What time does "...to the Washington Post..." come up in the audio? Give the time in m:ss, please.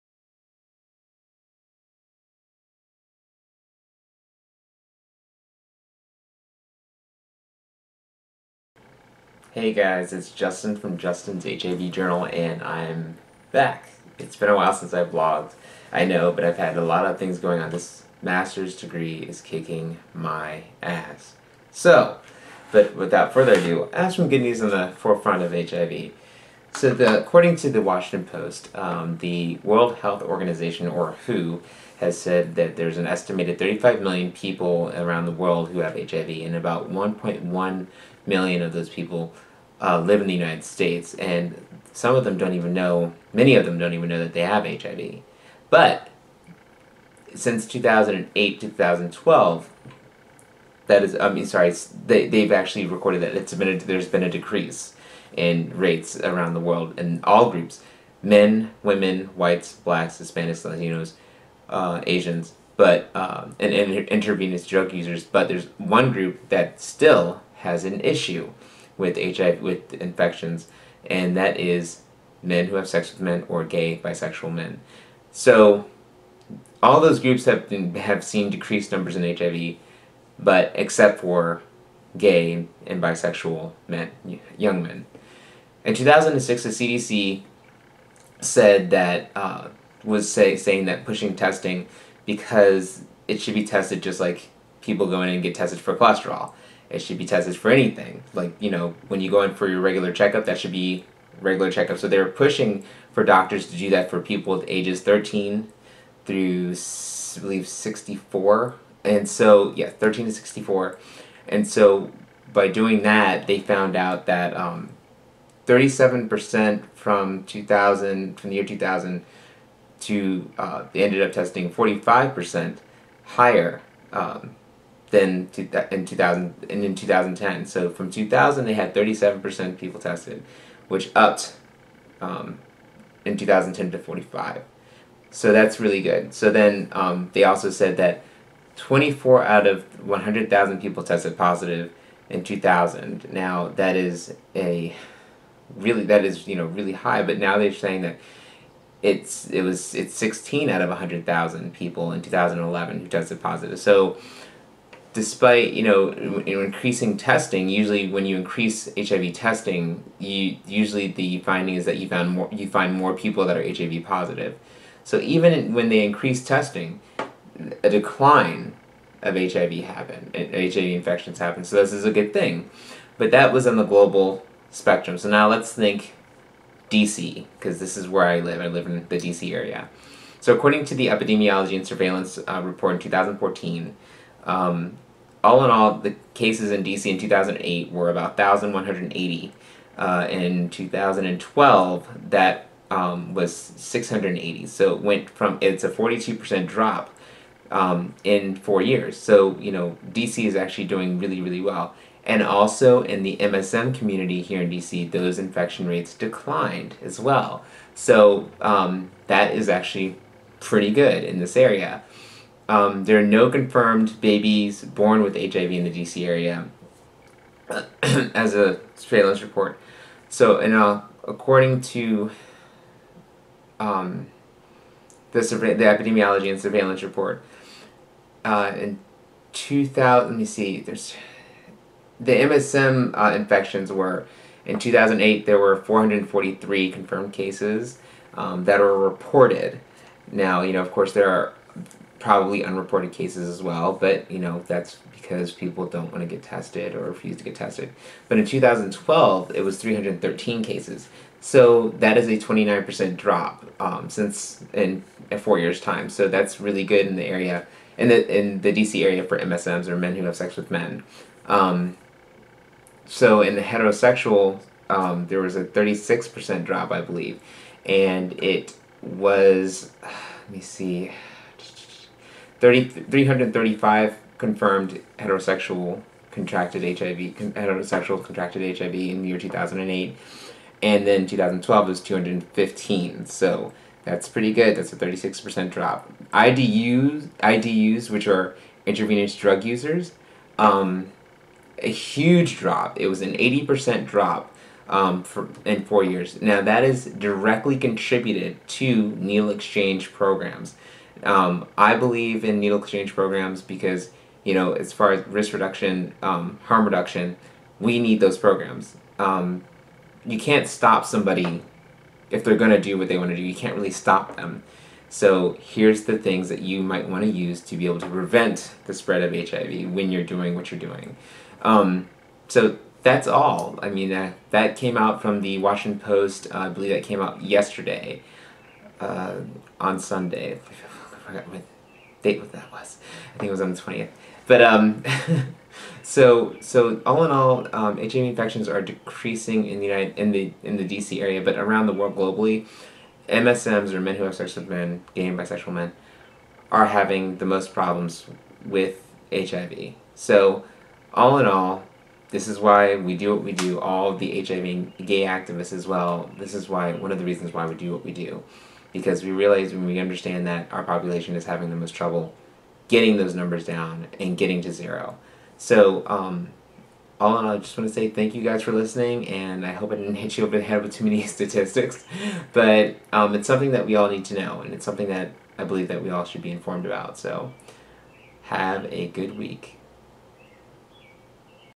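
0:27.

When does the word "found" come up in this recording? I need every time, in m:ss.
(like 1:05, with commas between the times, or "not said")
1:53, 2:42.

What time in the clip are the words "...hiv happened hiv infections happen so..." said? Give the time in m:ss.
2:49.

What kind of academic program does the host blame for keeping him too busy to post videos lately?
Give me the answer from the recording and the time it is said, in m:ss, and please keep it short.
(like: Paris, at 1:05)
master's degree, at 0:18.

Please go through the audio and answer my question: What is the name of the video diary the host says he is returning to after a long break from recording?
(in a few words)
Justin's HIV Journal.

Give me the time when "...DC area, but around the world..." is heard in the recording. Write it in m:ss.
5:40.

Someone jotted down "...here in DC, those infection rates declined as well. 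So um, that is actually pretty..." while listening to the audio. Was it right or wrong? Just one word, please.
right.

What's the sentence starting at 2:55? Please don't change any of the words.
So now let's think DC, because this is where I live.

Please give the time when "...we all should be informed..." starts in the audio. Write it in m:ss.
6:16.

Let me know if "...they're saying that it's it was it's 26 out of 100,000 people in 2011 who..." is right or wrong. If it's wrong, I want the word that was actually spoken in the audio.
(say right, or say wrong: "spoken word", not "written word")
wrong: "16", not "26".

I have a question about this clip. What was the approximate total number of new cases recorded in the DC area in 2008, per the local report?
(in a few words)
1,180.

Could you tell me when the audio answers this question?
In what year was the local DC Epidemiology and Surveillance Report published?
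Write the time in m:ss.
3:02.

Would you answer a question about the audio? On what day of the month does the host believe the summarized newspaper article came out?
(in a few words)
the 20th.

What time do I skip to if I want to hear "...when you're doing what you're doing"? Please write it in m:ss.
5:19.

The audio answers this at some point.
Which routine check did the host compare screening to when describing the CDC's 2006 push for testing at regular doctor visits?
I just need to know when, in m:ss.
1:35.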